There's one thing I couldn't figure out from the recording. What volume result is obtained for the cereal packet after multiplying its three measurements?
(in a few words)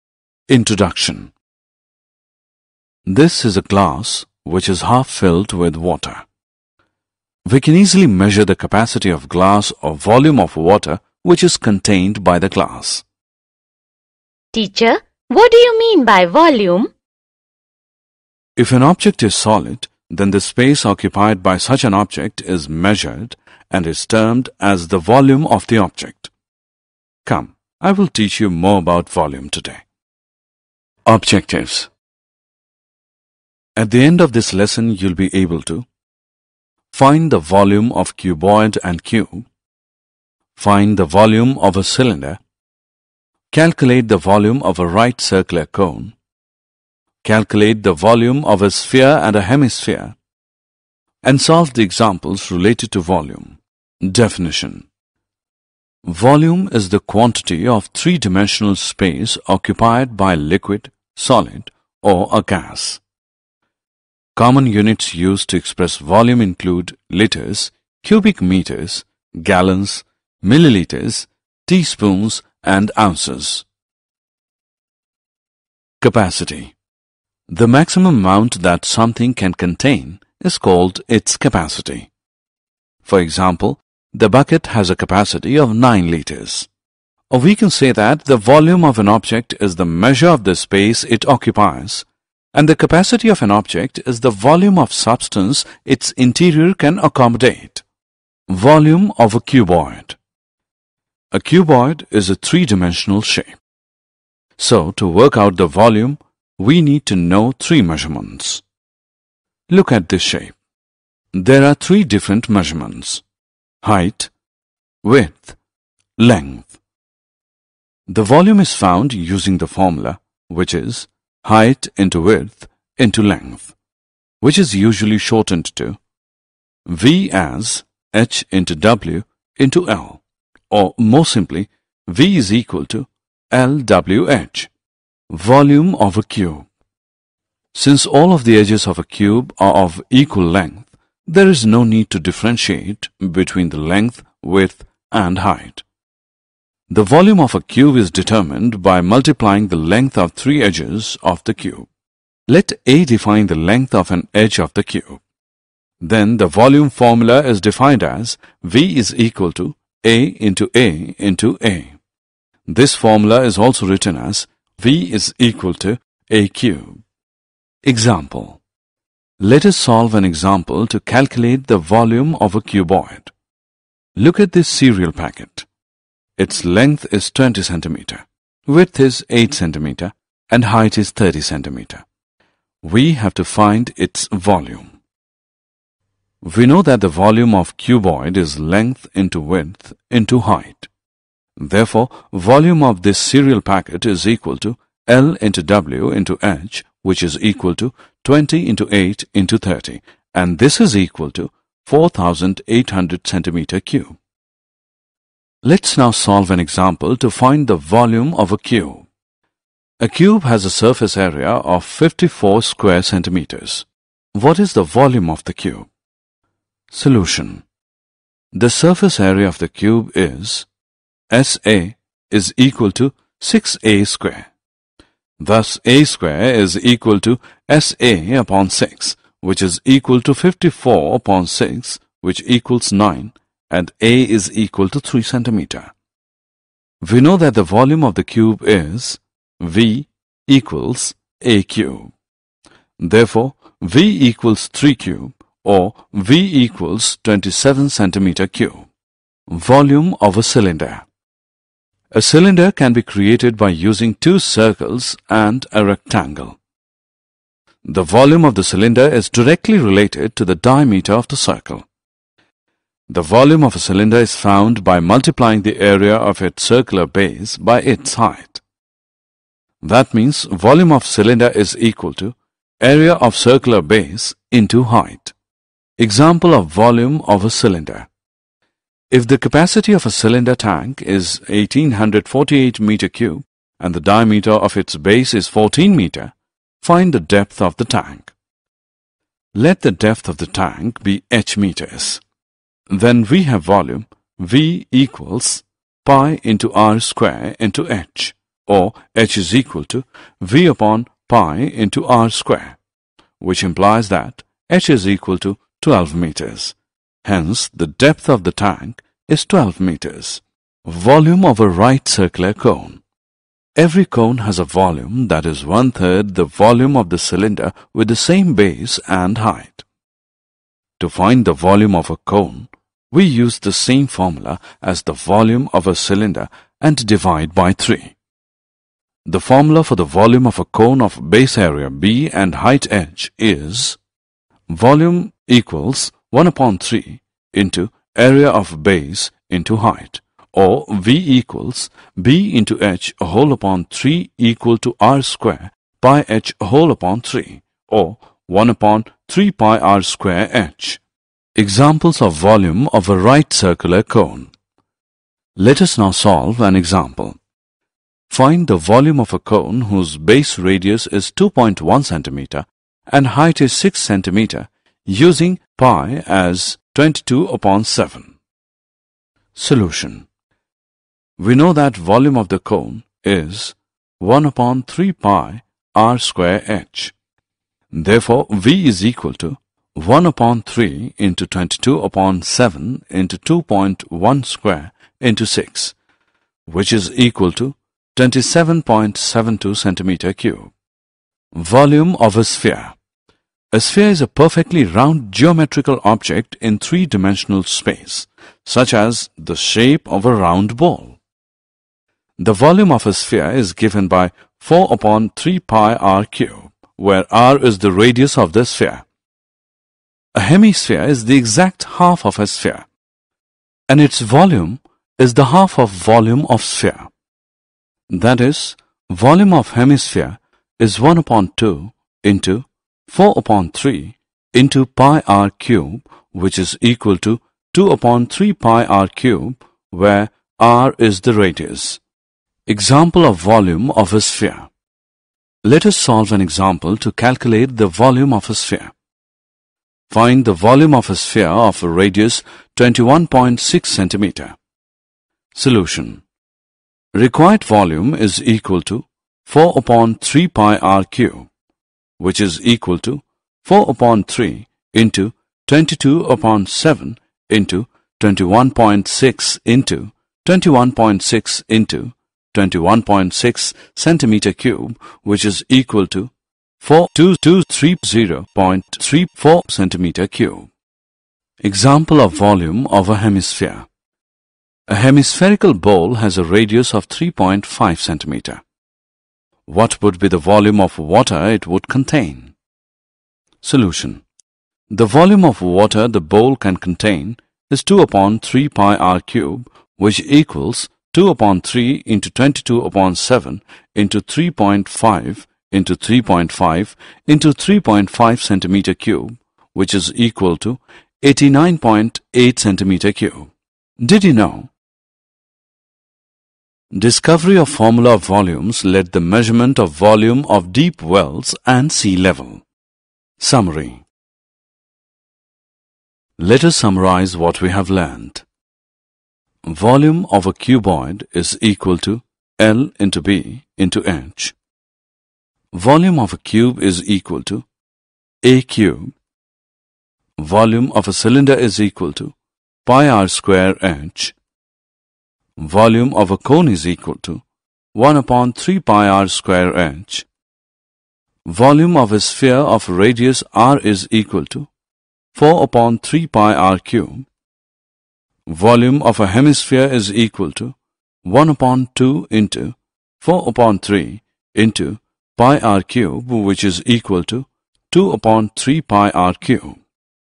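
4,800 cubic centimeters.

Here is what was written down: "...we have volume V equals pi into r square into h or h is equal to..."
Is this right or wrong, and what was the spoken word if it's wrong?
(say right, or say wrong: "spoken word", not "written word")
right.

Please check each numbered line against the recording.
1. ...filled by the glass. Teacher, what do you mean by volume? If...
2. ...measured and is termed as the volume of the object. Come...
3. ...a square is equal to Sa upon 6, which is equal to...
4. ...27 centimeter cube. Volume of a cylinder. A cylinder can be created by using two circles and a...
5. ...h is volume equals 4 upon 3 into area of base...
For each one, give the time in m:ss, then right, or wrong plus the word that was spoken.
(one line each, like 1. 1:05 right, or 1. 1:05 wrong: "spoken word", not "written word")
1. 0:11 wrong: "contained", not "filled"
2. 0:22 right
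3. 3:45 right
4. 4:07 right
5. 5:32 wrong: "1", not "4".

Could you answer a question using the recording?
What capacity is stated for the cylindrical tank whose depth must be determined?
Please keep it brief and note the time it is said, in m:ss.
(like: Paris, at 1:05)
1848 cubic meters, at 4:41.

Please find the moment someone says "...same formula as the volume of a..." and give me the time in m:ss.
5:23.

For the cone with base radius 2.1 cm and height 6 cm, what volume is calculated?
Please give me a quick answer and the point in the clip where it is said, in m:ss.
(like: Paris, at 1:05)
27.72 cubic centimeters, at 6:28.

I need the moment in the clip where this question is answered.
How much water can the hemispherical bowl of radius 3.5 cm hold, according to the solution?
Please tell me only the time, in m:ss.
8:21.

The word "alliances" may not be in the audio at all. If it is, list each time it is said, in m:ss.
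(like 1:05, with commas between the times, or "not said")
not said.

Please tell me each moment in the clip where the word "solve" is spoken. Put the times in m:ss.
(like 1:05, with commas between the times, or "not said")
0:51, 2:49, 3:26, 5:56, 7:15.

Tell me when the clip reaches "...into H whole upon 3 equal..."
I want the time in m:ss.
5:42.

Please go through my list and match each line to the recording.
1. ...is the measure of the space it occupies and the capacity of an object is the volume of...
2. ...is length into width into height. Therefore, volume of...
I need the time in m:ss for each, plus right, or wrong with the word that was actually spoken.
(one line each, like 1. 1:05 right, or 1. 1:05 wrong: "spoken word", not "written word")
1. 1:29 right
2. 3:08 right.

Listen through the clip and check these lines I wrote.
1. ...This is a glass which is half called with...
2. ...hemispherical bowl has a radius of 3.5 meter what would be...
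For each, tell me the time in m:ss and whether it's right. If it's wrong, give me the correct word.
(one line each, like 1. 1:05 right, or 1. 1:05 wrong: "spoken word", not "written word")
1. 0:03 wrong: "filled", not "called"
2. 7:54 wrong: "centimeter", not "meter".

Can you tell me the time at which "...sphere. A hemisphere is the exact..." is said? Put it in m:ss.
6:48.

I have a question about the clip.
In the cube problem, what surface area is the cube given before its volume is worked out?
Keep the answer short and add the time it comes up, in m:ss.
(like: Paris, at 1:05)
54 square centimeters, at 3:31.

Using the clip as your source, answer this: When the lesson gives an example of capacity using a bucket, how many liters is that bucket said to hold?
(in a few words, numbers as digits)
9 liters.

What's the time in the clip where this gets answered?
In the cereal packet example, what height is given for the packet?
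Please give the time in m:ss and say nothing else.
3:01.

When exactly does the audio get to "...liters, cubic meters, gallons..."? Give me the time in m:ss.
1:07.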